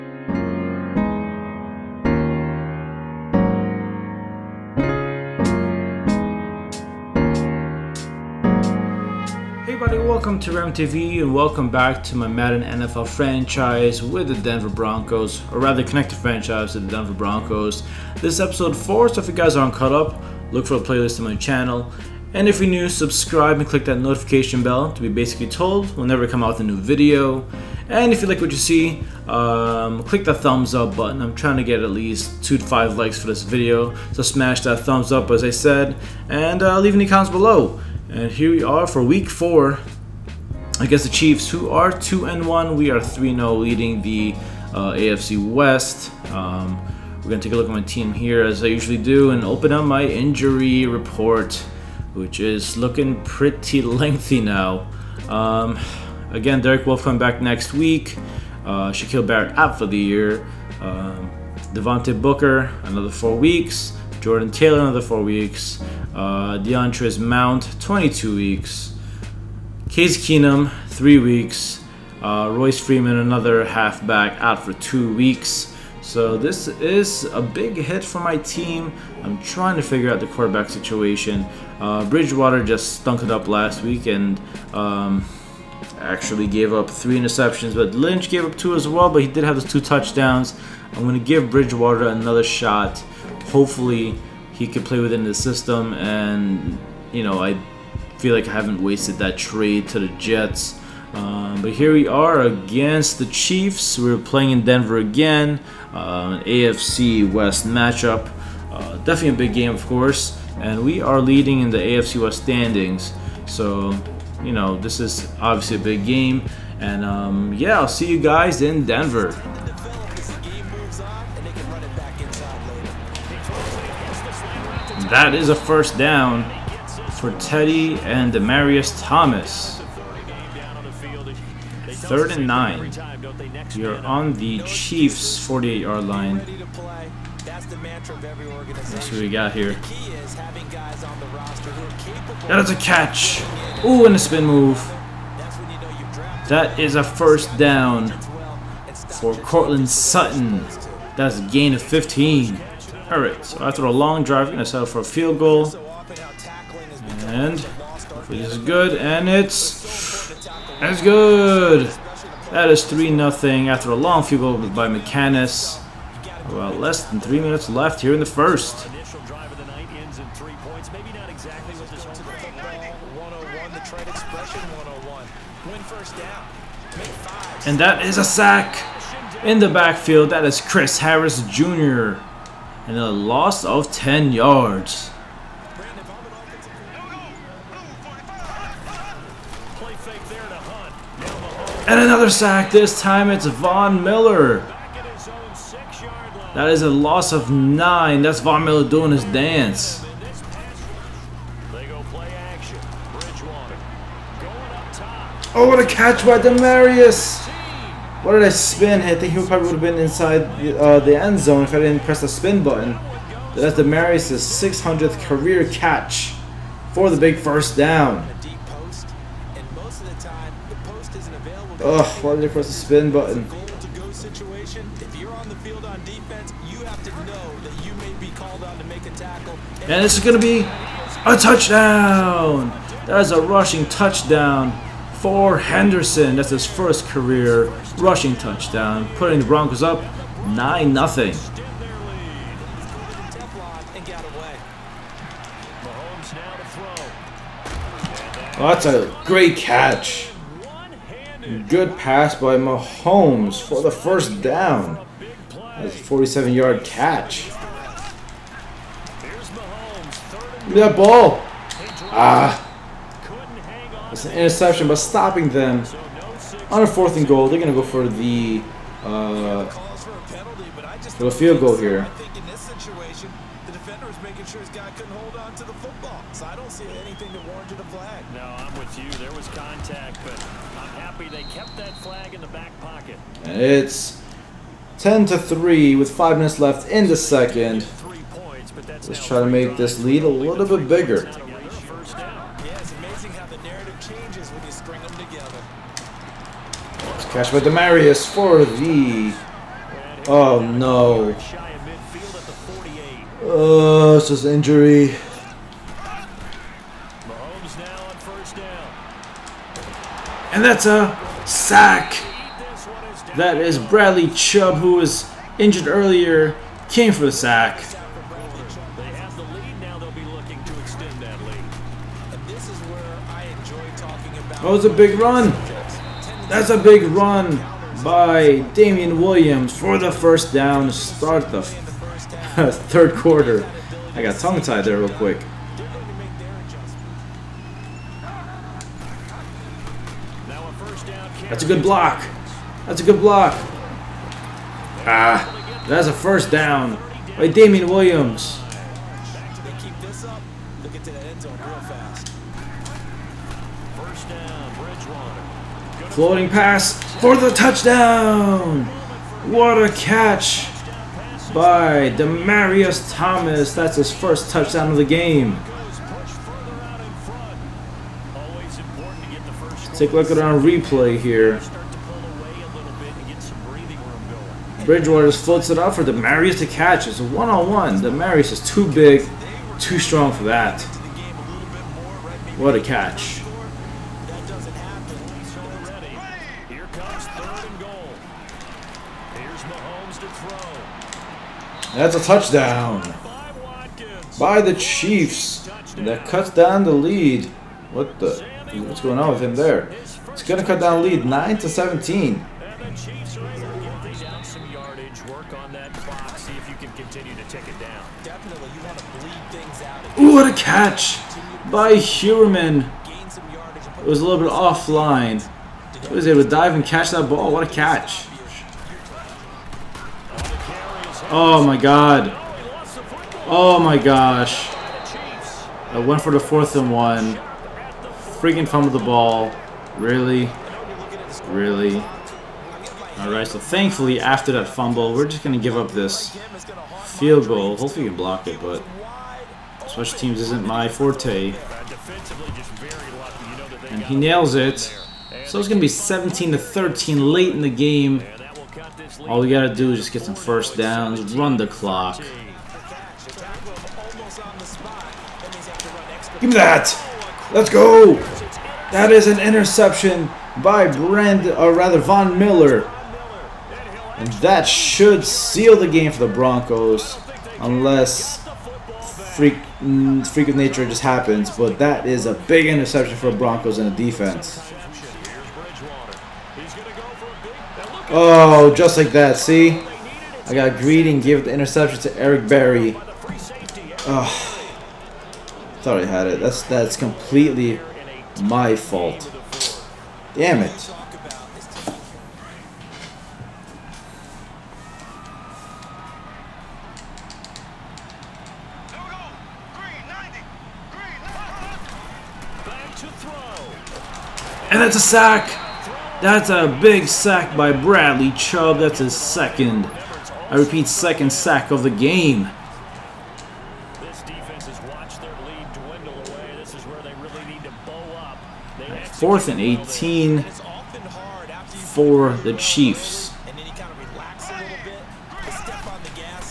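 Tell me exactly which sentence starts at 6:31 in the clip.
That's a touchdown by the Chiefs.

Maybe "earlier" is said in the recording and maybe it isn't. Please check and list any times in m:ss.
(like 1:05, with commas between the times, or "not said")
5:15.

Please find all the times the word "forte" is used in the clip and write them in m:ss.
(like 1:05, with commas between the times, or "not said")
7:20.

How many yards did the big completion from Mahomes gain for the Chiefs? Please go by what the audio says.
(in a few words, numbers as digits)
47.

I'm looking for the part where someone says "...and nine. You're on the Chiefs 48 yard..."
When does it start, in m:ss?
2:12.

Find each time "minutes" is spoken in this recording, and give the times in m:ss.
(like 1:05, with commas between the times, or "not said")
2:47, 4:46.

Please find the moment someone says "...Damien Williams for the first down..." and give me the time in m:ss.
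5:28.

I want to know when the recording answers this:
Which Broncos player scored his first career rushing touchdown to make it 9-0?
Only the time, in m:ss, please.
3:55.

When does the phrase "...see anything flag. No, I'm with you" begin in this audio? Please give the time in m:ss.
4:36.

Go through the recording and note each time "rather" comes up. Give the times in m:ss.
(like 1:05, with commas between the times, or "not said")
0:15, 7:41.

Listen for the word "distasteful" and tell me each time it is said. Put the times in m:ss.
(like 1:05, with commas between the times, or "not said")
not said.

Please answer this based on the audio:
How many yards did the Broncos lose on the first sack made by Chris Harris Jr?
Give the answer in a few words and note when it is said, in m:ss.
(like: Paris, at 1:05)
10, at 3:03.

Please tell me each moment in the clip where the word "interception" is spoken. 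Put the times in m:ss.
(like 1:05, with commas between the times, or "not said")
1:27, 4:24, 7:39, 7:52, 8:01.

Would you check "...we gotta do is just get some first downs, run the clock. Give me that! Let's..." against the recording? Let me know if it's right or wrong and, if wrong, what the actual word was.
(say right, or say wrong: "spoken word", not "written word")
right.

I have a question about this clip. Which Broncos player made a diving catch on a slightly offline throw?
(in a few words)
Heuerman.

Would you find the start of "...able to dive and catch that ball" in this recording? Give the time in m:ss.
6:56.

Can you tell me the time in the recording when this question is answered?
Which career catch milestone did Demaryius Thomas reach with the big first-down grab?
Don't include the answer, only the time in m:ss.
3:34.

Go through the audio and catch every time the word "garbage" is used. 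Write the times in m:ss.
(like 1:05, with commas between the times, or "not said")
not said.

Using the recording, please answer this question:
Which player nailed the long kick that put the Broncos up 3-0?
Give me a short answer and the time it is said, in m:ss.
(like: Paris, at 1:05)
McManus, at 2:44.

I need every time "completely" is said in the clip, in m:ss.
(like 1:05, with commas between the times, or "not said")
8:06.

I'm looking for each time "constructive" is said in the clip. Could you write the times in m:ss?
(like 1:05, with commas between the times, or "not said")
not said.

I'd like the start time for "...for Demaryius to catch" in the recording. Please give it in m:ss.
6:15.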